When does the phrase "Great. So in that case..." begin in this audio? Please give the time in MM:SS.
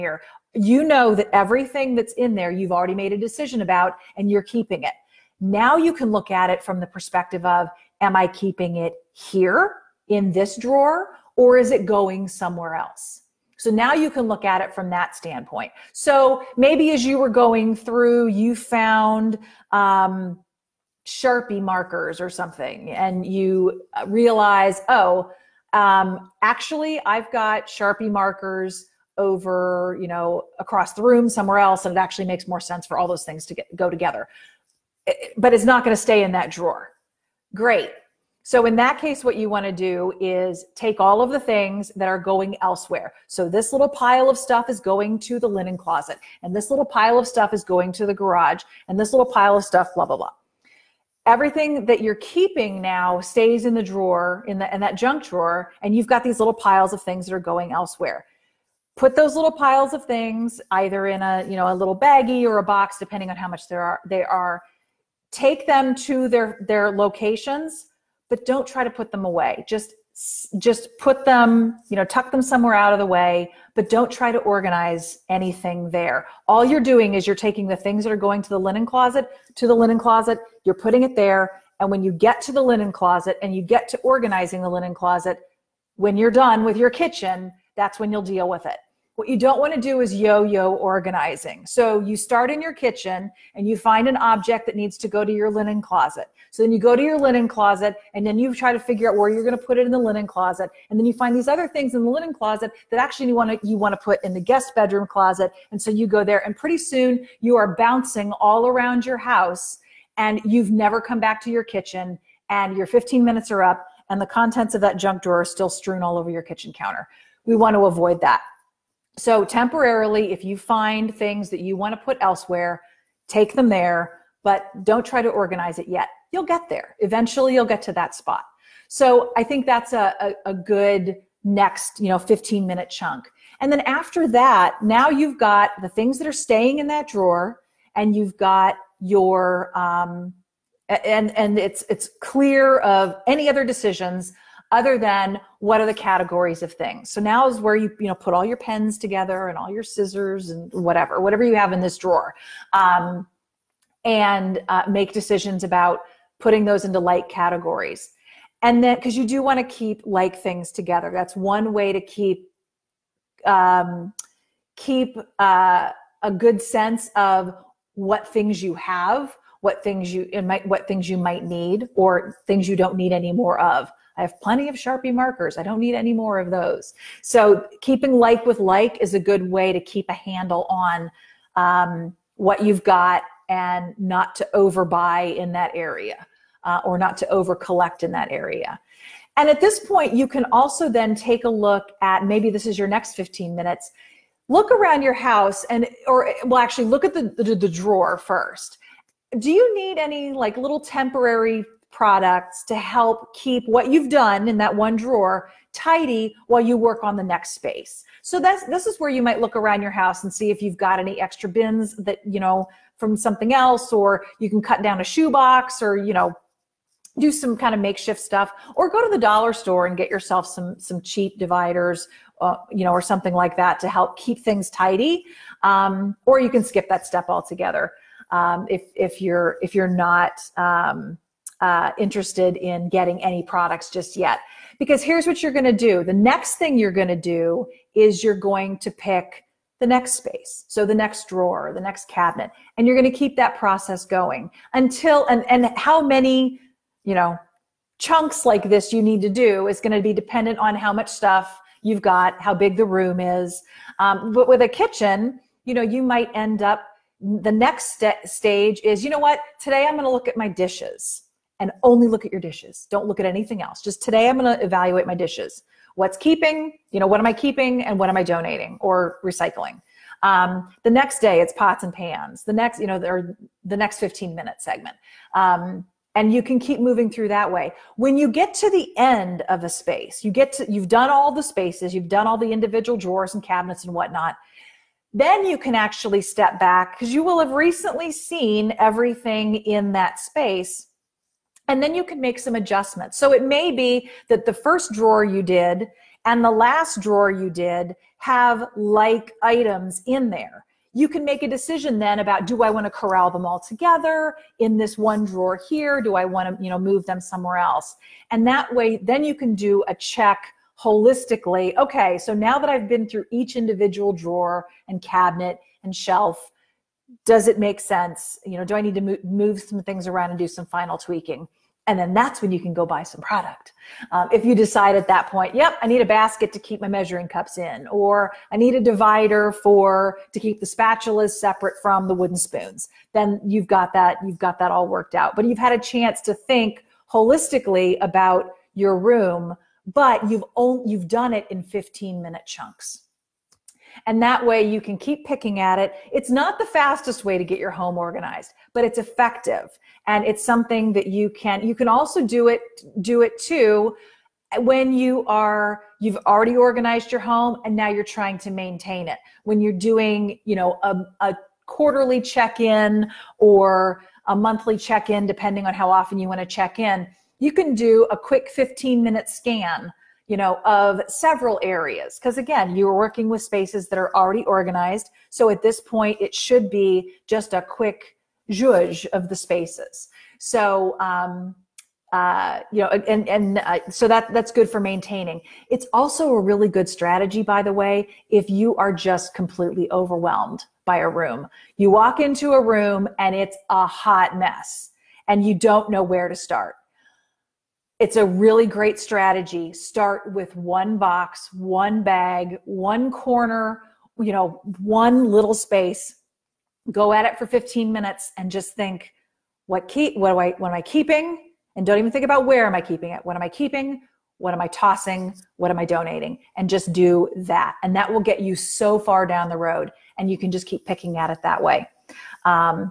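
00:37.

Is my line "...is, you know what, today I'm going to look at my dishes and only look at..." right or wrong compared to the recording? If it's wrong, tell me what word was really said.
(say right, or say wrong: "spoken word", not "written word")
right.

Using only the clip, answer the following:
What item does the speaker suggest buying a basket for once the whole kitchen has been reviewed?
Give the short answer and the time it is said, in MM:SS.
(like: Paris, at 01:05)
measuring cups, at 05:26.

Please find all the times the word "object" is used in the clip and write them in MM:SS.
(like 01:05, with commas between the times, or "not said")
01:34.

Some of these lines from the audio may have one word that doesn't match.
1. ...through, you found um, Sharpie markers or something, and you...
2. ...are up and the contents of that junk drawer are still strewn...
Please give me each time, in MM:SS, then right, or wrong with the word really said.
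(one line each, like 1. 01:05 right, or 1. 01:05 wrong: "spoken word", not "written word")
1. 00:17 right
2. 01:53 right.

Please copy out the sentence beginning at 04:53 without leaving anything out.
So it may be that the first drawer you did and the last drawer you did have like items in there.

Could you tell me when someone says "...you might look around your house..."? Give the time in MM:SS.
03:29.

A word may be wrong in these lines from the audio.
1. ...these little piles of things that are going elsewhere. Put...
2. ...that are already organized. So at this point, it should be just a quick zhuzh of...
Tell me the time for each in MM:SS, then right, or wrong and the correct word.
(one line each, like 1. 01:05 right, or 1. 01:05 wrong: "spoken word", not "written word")
1. 00:56 right
2. 06:13 right.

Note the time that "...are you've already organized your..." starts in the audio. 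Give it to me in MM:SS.
05:55.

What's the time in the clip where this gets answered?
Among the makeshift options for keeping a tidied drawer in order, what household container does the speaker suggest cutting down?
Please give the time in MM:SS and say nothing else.
03:35.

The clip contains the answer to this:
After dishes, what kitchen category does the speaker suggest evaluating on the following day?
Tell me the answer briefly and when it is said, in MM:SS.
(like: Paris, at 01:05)
pots and pans, at 04:31.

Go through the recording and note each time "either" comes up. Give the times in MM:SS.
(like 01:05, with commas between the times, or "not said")
01:00.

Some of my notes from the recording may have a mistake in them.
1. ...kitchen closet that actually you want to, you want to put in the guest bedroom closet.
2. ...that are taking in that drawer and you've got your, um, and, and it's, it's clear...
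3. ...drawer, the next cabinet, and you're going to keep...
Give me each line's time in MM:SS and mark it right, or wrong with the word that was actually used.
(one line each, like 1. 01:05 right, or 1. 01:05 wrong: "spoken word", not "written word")
1. 01:42 wrong: "linen", not "kitchen"
2. 02:16 wrong: "staying", not "taking"
3. 04:01 right.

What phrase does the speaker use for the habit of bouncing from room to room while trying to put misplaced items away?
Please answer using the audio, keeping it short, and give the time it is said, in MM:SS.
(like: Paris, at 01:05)
yo yo organizing, at 01:30.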